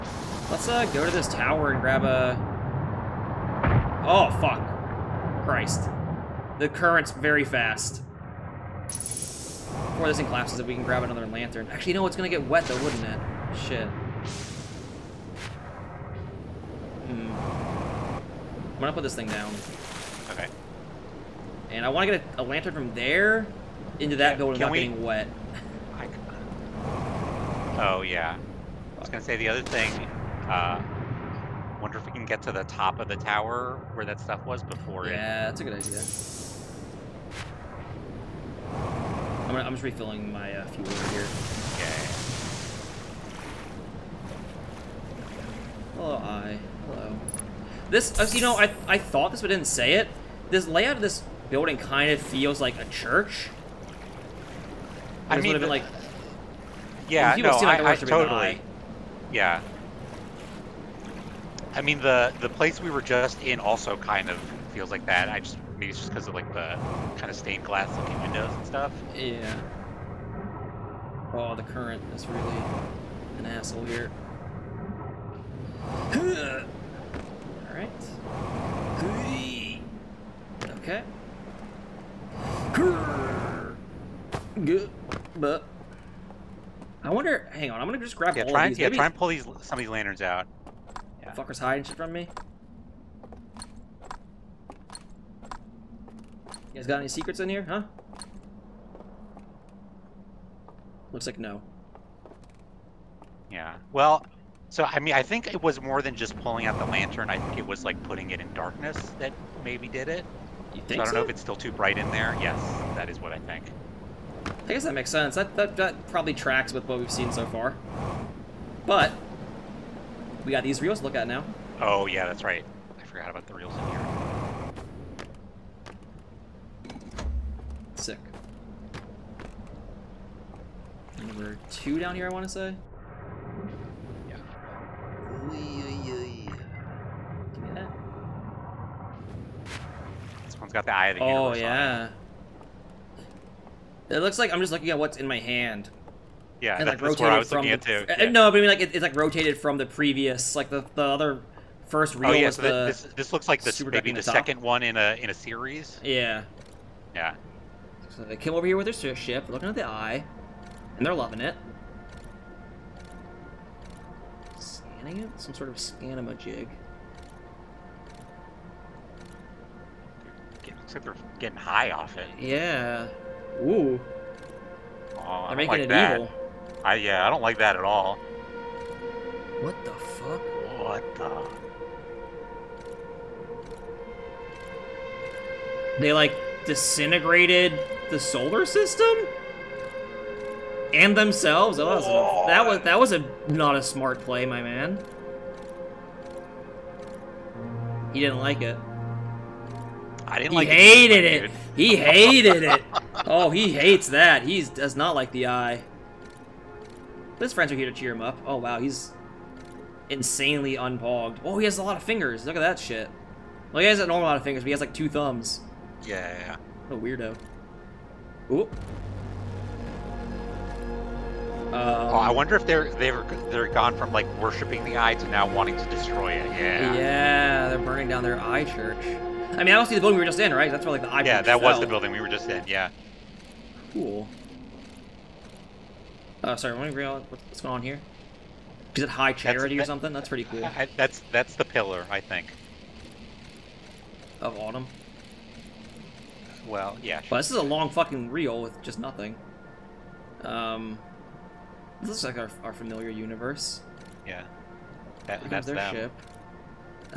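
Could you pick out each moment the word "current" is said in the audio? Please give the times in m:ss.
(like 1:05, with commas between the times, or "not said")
0:06, 1:11.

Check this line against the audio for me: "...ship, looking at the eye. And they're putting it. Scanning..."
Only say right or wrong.
wrong.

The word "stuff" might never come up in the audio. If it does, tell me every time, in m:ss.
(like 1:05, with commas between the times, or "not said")
0:34, 1:08.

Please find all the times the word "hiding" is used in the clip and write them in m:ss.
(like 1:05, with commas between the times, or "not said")
1:31.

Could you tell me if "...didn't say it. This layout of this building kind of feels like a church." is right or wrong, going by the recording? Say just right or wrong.
right.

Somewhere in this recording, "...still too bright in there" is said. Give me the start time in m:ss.
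1:51.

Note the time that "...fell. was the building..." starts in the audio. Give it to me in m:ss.
3:51.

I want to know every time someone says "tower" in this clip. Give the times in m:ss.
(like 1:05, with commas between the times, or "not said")
0:01, 0:33.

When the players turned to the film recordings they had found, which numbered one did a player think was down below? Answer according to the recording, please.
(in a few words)
2.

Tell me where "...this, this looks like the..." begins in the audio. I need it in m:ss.
2:32.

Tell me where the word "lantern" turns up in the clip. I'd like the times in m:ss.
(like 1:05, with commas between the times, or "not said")
0:11, 0:22, 1:29, 1:46.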